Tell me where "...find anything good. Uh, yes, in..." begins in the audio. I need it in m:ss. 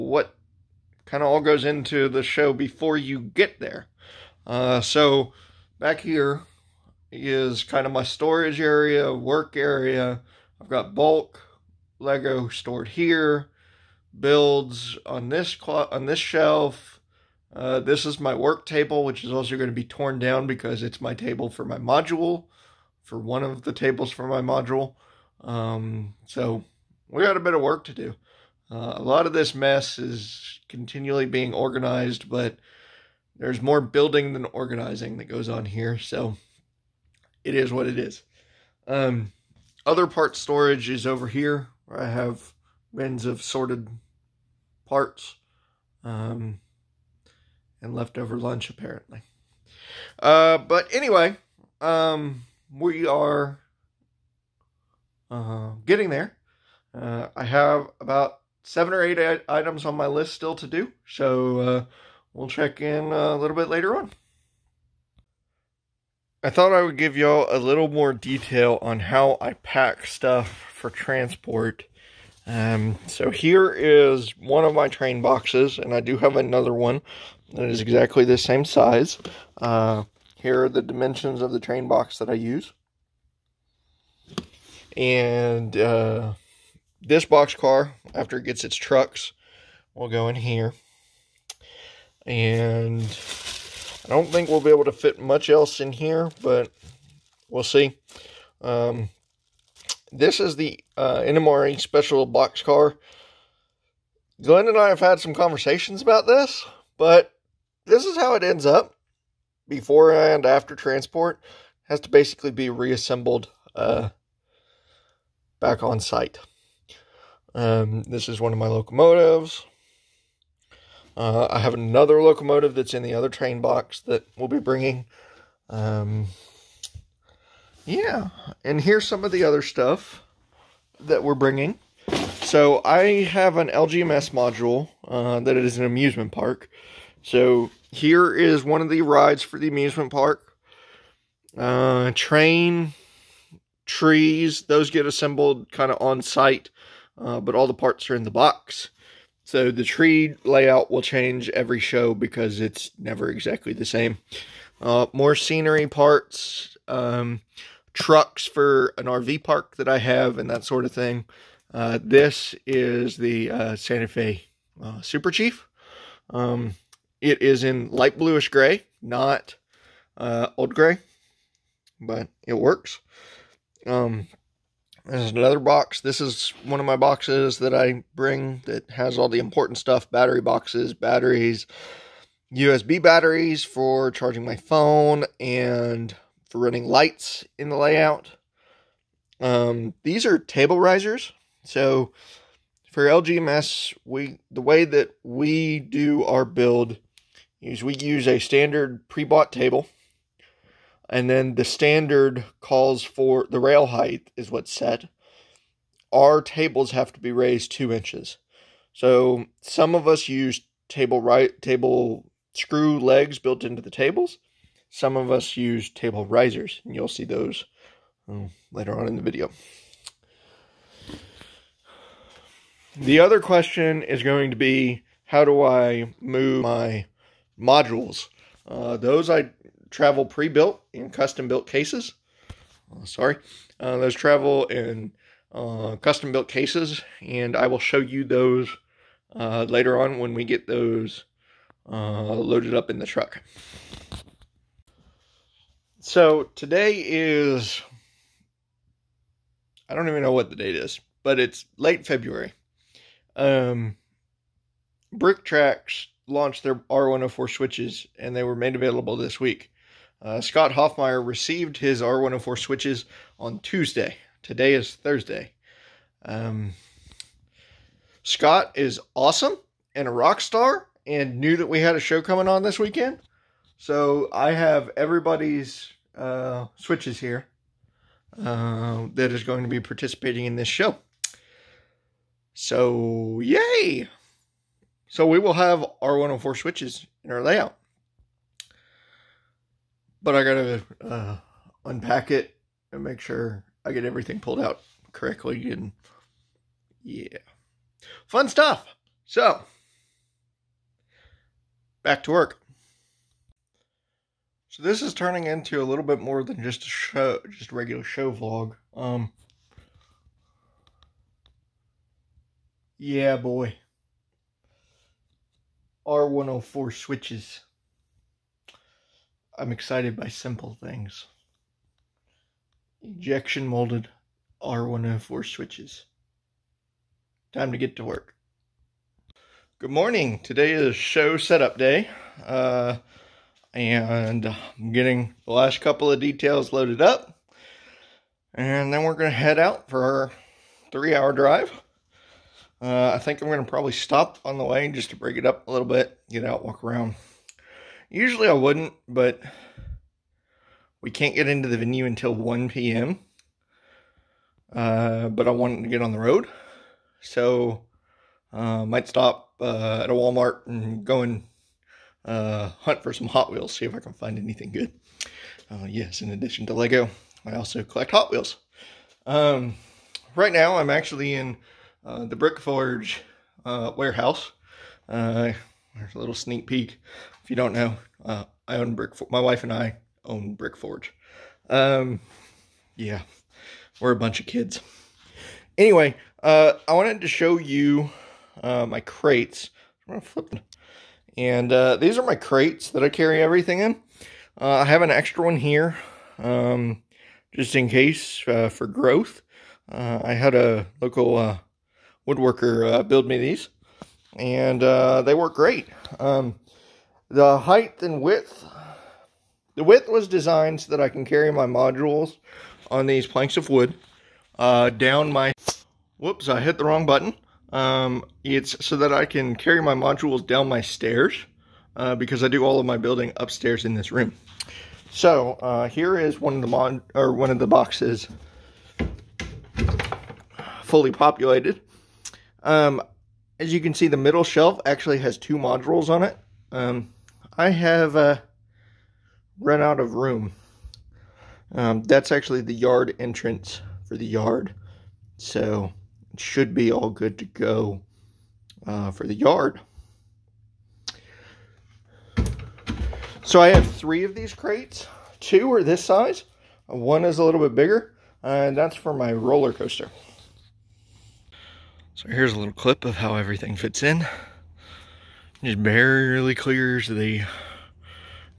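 6:04.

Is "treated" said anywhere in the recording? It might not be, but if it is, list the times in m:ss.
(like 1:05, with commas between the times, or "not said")
not said.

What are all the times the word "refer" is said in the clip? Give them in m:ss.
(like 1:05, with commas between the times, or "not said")
not said.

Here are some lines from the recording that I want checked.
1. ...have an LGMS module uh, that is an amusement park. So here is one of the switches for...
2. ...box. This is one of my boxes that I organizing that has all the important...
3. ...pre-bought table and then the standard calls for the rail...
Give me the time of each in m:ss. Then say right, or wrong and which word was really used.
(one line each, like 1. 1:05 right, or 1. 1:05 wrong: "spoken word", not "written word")
1. 2:13 wrong: "rides", not "switches"
2. 2:55 wrong: "bring", not "organizing"
3. 3:19 right.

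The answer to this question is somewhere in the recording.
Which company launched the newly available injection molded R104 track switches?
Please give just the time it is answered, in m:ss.
4:15.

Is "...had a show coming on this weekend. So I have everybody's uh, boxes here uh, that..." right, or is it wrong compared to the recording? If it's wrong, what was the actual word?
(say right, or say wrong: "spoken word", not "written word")
wrong: "switches", not "boxes".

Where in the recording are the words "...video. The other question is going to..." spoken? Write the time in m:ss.
3:39.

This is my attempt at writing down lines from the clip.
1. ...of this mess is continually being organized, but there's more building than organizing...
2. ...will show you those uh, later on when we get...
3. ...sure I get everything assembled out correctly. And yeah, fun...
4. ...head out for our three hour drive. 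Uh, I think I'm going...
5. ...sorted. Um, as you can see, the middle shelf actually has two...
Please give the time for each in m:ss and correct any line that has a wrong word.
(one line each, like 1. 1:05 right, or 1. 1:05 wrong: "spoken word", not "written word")
1. 0:29 right
2. 3:57 right
3. 4:53 wrong: "pulled", not "assembled"
4. 5:39 right
5. 7:11 wrong: "populated", not "sorted".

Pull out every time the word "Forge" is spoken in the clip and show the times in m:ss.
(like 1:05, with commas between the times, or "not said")
6:12, 6:20.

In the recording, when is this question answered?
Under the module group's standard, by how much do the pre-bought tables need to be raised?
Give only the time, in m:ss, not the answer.
3:27.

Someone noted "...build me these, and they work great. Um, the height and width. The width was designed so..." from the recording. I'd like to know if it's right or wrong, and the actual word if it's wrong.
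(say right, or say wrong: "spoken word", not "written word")
right.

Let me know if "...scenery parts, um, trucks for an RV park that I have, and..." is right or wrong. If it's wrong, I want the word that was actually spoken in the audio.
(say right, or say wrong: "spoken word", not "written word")
right.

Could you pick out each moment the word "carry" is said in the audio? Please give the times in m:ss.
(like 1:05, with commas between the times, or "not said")
6:33, 6:51, 6:59.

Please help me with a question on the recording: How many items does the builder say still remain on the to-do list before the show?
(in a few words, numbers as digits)
7 or 8.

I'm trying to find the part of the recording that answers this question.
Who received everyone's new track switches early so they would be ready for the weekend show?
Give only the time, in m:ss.
4:20.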